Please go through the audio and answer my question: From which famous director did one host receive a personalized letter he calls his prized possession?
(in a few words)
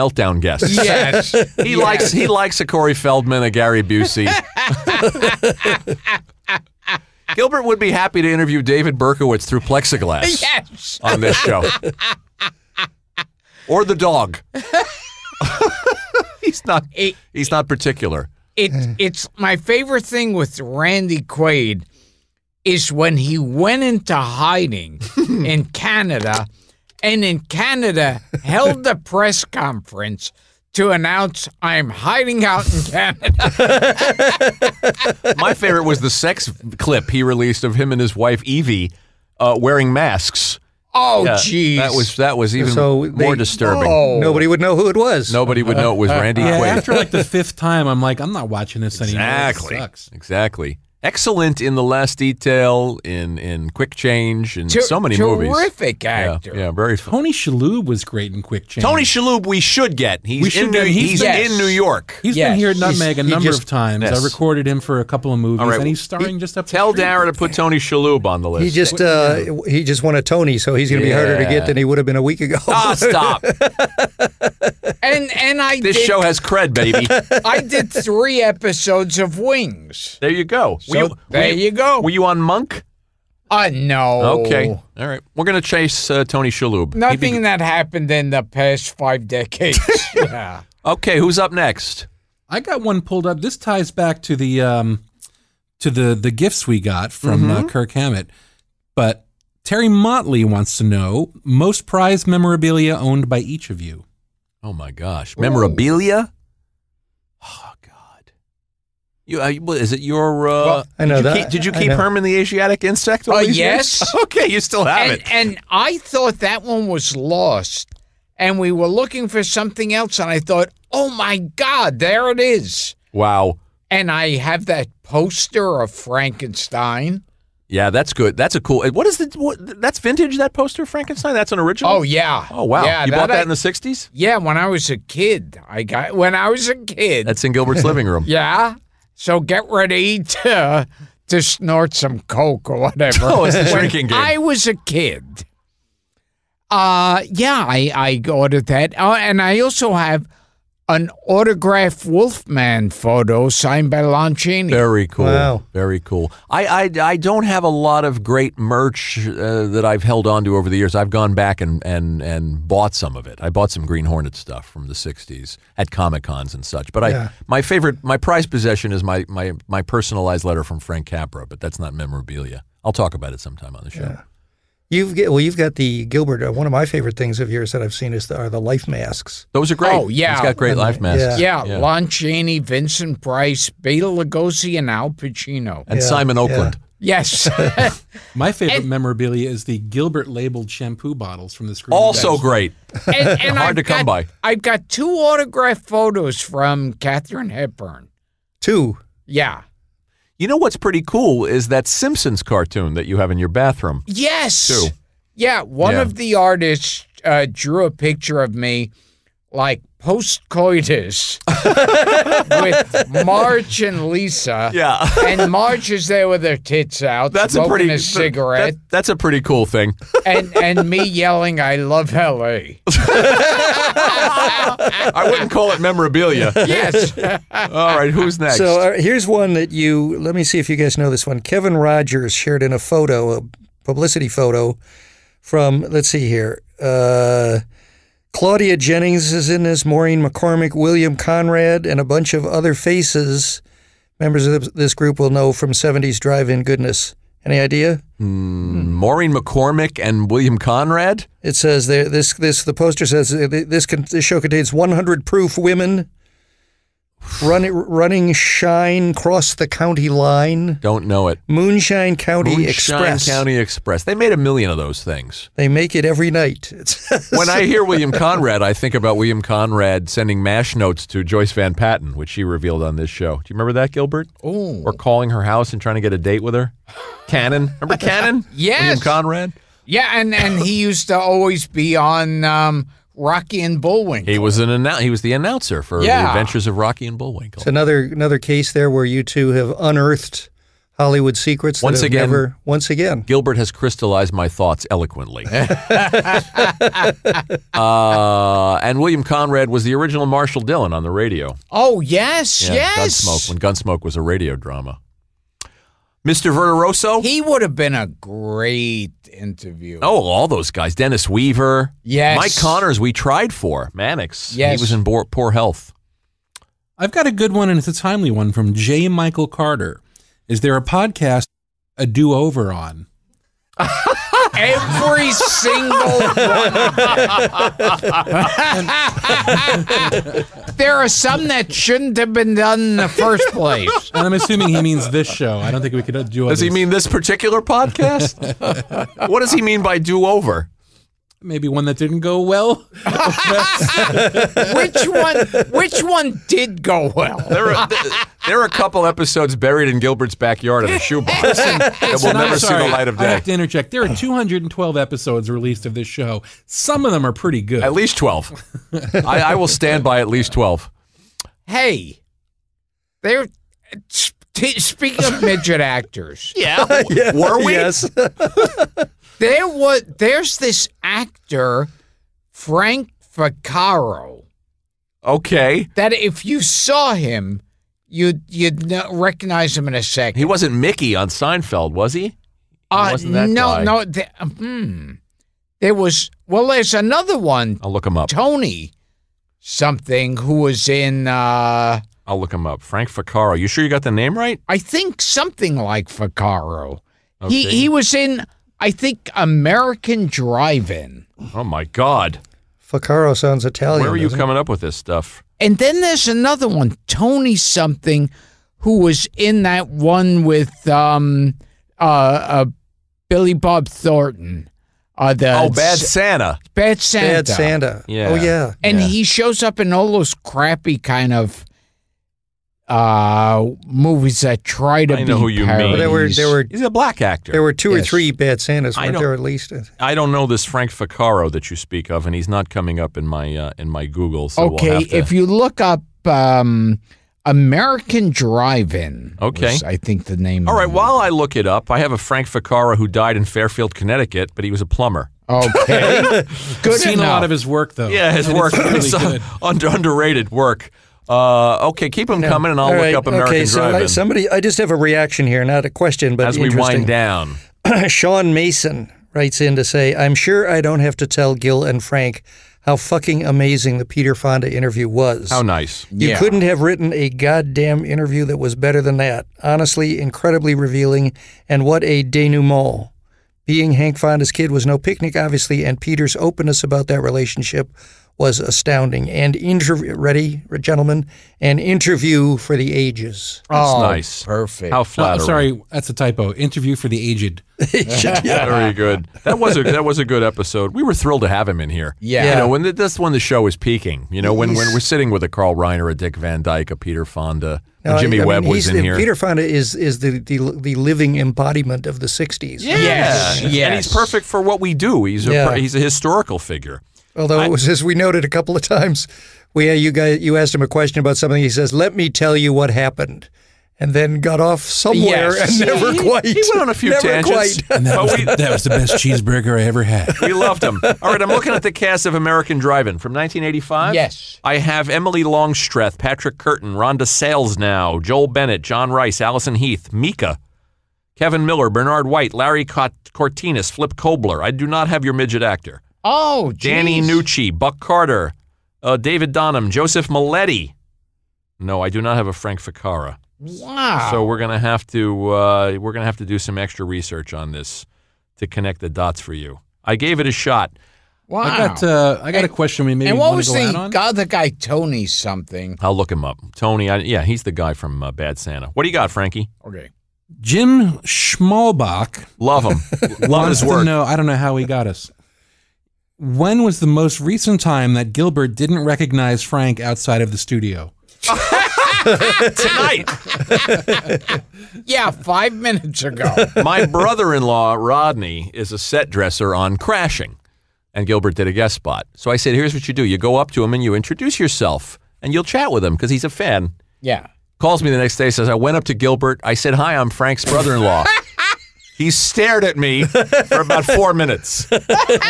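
Frank Capra.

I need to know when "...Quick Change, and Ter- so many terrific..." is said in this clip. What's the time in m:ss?
0:53.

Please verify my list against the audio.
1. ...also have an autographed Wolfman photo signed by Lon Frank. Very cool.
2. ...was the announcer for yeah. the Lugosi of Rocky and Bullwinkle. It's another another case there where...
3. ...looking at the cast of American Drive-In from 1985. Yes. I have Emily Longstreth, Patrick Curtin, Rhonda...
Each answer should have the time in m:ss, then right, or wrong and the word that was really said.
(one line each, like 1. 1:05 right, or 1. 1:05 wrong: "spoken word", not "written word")
1. 2:29 wrong: "Chaney", not "Frank"
2. 4:45 wrong: "Adventures", not "Lugosi"
3. 8:41 right.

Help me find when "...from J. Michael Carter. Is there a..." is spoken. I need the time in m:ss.
5:18.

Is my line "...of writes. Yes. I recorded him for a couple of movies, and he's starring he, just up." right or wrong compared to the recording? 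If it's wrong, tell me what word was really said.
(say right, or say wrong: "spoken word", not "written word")
wrong: "times", not "writes".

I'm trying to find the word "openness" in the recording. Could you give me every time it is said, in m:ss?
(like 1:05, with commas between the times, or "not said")
7:56.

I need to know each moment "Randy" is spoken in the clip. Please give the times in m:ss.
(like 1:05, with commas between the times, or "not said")
0:20, 0:46.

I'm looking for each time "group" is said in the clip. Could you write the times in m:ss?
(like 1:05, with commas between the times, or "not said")
4:04.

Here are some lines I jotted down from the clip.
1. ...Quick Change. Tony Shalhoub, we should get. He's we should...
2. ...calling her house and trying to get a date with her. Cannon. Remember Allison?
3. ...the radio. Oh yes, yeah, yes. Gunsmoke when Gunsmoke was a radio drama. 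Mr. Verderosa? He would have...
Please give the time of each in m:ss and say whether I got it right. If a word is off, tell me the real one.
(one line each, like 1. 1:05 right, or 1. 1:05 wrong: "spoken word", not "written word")
1. 0:58 right
2. 4:34 wrong: "Cannon", not "Allison"
3. 5:01 right.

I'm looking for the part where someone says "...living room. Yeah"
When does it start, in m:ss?
2:17.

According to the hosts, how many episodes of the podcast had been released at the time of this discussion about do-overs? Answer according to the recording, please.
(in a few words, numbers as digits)
212.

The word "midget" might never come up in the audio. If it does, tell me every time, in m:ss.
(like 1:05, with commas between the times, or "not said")
6:05, 8:55.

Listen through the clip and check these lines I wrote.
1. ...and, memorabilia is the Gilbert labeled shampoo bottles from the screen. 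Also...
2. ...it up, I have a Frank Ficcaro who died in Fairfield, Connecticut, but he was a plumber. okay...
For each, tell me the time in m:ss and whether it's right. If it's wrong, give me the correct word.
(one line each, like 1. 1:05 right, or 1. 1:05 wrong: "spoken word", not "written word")
1. 3:08 right
2. 7:21 right.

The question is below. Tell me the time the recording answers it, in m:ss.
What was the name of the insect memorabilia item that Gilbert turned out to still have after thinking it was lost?
1:51.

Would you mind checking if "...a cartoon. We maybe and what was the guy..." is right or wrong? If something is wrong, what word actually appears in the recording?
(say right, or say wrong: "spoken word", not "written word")
wrong: "question", not "cartoon".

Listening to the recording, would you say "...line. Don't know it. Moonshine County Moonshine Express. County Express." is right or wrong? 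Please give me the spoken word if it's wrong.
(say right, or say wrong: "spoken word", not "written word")
right.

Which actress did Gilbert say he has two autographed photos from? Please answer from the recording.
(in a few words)
Katharine Hepburn.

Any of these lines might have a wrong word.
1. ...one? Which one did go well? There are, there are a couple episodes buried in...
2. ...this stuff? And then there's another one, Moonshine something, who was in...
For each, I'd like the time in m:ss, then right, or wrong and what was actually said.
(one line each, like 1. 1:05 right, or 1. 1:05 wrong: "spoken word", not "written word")
1. 5:45 right
2. 6:44 wrong: "Tony", not "Moonshine".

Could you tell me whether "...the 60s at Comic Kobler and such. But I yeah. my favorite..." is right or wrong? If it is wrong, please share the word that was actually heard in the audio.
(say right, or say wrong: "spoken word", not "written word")
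wrong: "Cons", not "Kobler".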